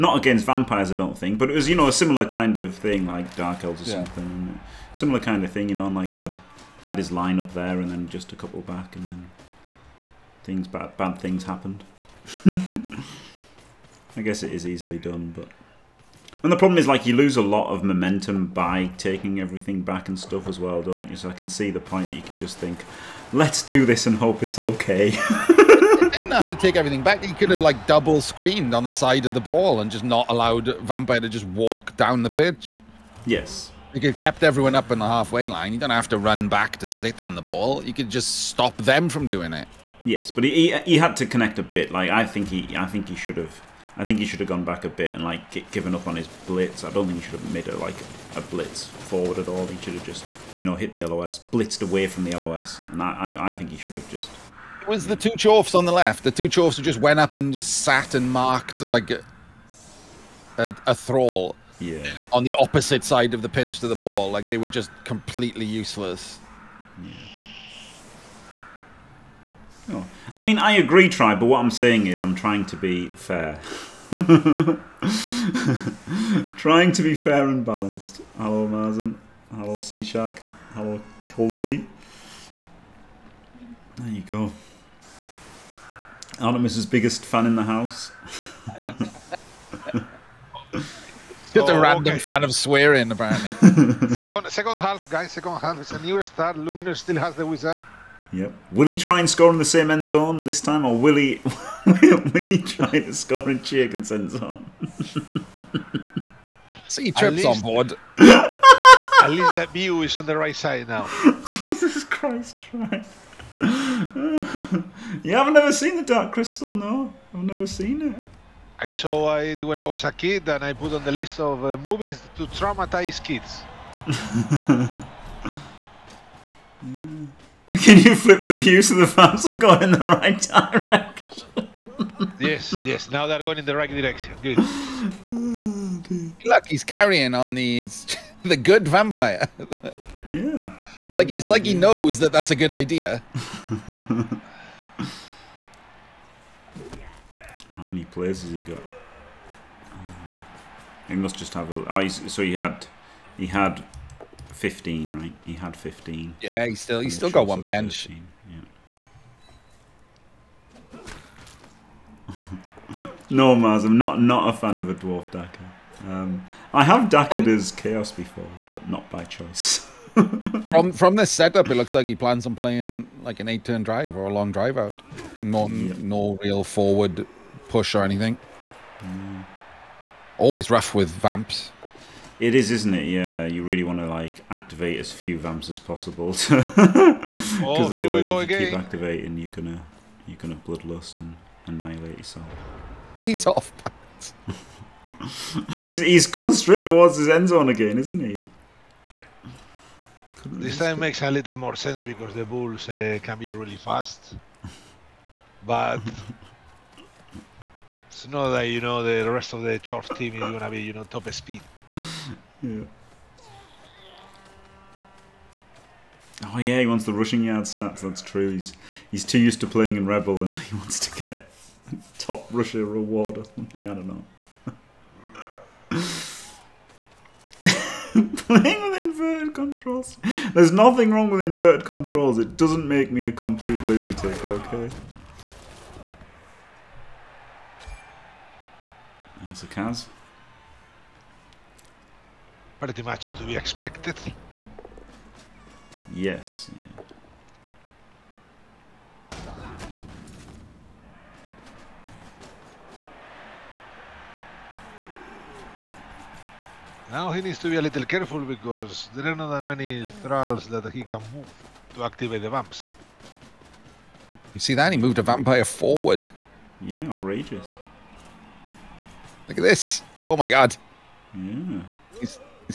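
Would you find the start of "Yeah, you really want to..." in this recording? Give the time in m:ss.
3:03.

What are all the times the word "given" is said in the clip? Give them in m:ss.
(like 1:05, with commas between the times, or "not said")
0:45.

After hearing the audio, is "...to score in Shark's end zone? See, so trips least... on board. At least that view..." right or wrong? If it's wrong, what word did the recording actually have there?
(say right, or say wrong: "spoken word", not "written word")
wrong: "Chiakin", not "Shark".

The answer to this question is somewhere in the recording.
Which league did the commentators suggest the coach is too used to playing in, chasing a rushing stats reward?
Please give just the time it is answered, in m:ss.
3:40.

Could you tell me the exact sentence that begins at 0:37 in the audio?
You could just stop them from doing it.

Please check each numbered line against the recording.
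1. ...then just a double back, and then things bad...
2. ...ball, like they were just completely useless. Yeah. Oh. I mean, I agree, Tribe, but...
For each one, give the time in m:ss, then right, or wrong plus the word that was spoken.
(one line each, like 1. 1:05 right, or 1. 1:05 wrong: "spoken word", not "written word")
1. 0:07 wrong: "couple", not "double"
2. 1:03 right.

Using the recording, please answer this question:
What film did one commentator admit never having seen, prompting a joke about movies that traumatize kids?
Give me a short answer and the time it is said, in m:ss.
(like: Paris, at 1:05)
The Dark Crystal, at 1:56.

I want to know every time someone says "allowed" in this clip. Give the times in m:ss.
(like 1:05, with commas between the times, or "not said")
0:30.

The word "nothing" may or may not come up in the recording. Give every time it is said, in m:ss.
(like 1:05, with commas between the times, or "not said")
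3:50.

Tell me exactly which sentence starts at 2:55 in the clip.
No, no real forward push or anything.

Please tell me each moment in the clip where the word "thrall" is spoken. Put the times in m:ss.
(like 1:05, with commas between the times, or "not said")
1:00, 4:20.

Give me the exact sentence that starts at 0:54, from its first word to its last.
It was the two chorfs on the left.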